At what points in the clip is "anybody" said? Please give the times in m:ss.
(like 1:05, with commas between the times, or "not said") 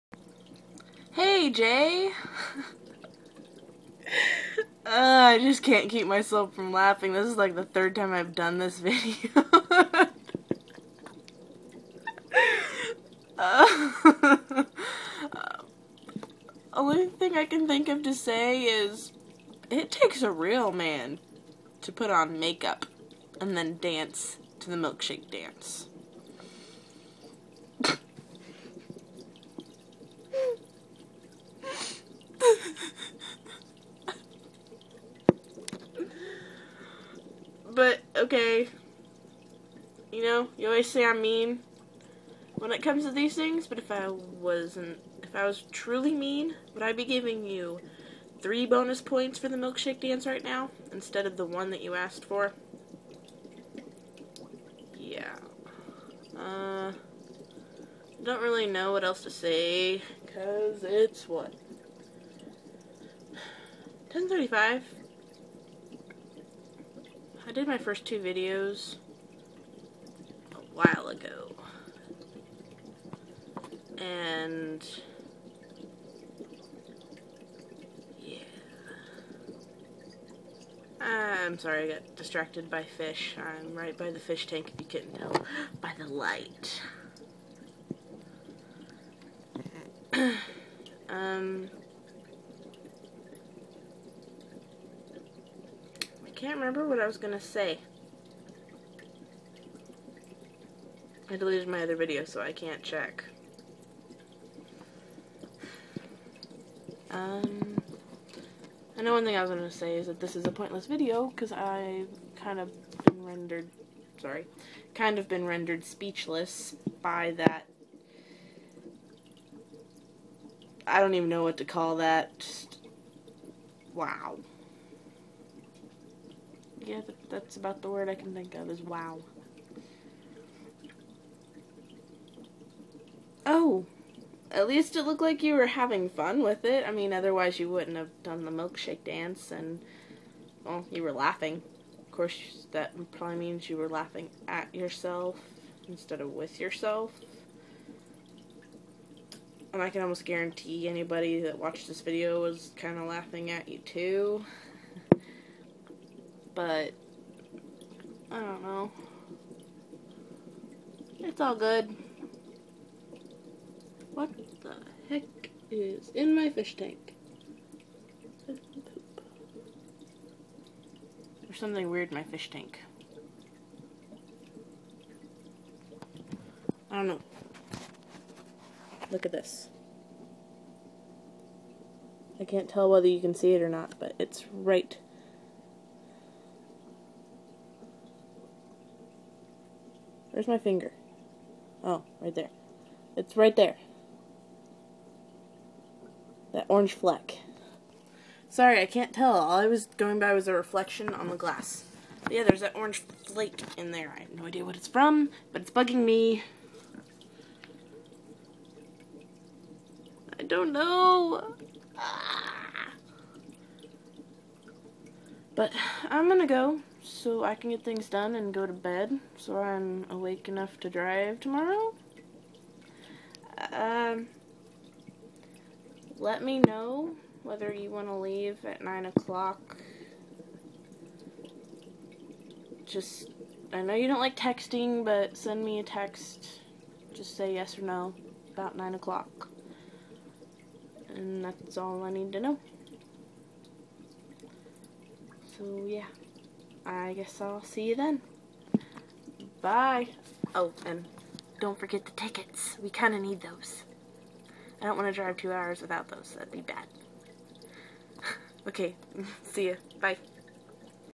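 2:30.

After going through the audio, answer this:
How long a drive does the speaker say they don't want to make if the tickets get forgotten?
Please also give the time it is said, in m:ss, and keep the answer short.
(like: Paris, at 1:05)
2 hours, at 4:15.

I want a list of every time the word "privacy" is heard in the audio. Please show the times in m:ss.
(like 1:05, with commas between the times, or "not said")
not said.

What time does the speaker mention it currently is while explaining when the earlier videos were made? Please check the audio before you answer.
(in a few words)
10:35.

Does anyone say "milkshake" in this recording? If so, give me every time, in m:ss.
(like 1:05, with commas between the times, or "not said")
0:24, 0:49, 2:18.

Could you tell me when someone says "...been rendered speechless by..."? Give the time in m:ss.
1:55.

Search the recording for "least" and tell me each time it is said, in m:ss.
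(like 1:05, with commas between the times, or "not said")
2:14.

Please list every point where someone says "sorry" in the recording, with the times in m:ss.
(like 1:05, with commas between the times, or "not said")
1:21, 1:54, 3:18.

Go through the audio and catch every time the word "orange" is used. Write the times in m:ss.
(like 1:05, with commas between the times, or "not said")
3:16, 3:22.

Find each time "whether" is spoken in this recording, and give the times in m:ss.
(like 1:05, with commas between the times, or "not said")
3:02, 3:47.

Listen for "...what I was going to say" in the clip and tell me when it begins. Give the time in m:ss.
1:36.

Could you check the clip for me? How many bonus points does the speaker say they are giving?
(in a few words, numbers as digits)
3.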